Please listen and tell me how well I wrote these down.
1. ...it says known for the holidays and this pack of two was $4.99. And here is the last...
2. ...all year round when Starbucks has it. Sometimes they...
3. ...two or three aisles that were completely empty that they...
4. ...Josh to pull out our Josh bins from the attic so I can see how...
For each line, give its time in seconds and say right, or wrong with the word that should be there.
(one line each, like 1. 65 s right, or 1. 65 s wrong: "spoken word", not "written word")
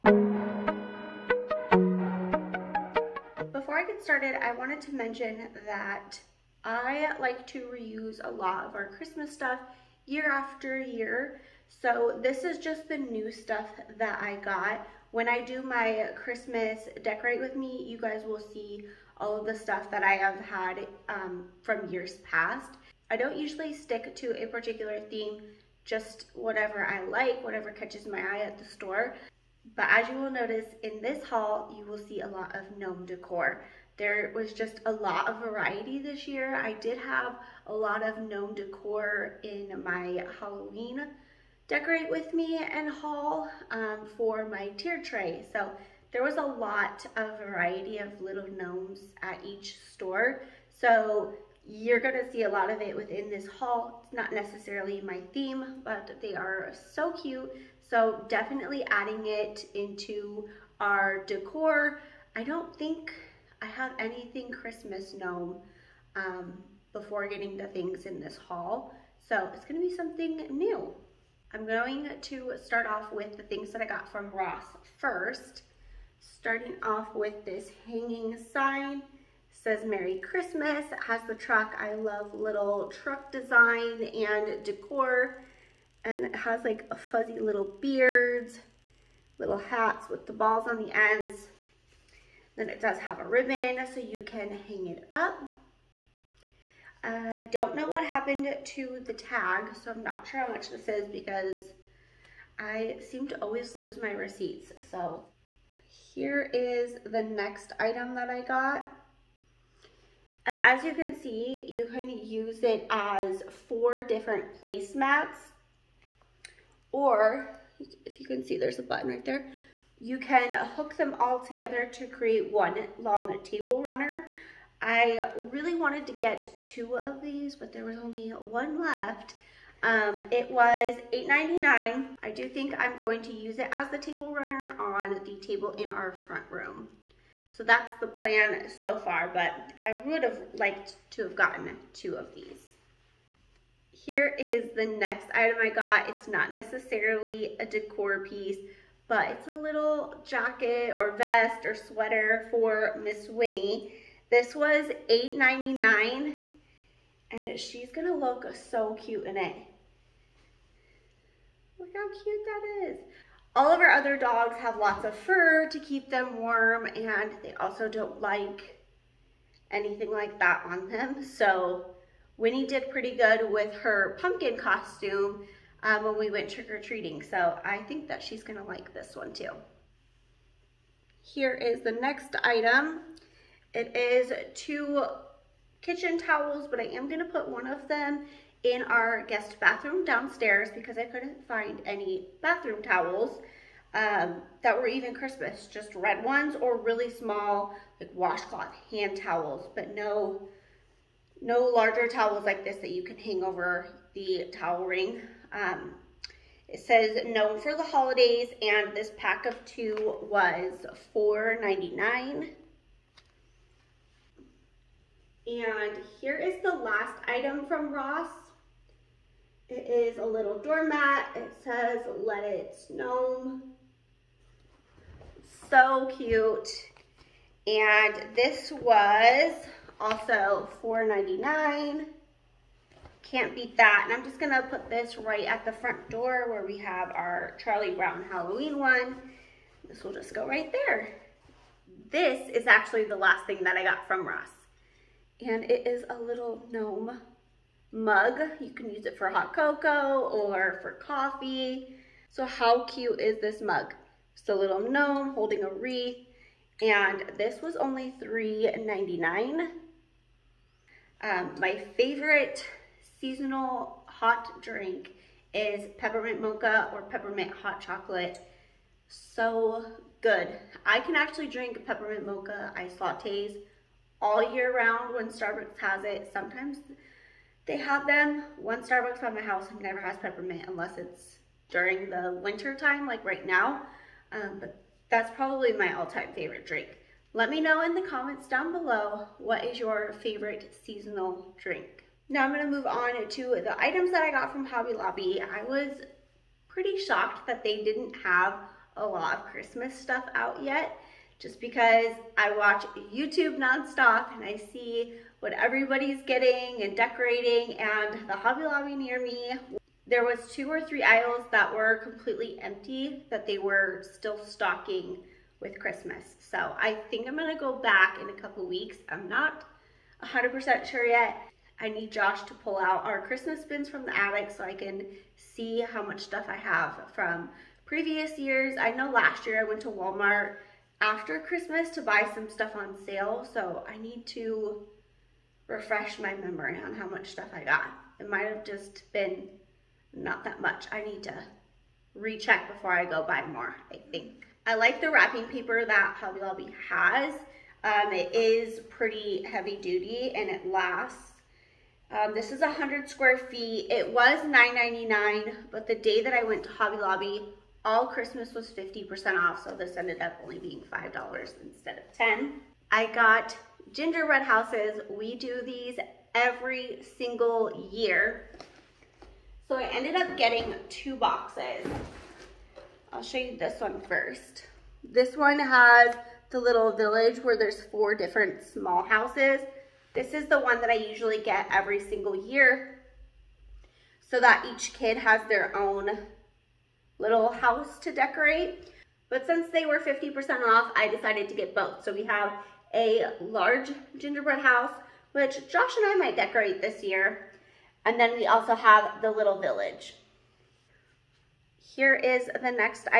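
1. 206 s right
2. 274 s right
3. 310 s right
4. 322 s wrong: "Christmas", not "Josh".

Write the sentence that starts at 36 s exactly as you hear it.
I did have a lot of gnome decor in my Halloween decorate with me and haul um, for my tier tray.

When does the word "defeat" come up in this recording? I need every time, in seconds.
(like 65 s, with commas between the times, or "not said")
not said.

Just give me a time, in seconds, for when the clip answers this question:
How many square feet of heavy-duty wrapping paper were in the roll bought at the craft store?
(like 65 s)
352 s.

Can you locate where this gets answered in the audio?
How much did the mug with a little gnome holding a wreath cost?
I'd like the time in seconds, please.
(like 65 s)
258 s.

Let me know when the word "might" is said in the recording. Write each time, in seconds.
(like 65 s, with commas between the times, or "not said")
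338 s, 396 s.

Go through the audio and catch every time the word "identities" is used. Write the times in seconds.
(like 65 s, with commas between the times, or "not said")
not said.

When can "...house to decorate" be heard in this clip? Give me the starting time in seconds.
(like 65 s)
387 s.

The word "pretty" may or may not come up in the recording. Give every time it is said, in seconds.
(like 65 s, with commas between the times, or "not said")
172 s, 296 s, 348 s.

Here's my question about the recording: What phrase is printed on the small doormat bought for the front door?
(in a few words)
Let it snow.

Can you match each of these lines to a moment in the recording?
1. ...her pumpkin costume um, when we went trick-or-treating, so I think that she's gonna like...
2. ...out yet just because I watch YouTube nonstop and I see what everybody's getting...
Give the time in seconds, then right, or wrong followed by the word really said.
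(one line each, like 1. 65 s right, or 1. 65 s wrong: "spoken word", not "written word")
1. 173 s right
2. 300 s right.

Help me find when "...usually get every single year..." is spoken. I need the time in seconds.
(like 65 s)
380 s.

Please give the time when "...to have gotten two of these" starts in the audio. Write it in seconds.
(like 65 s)
141 s.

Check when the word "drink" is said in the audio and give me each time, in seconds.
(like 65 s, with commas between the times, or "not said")
264 s, 271 s, 286 s, 291 s.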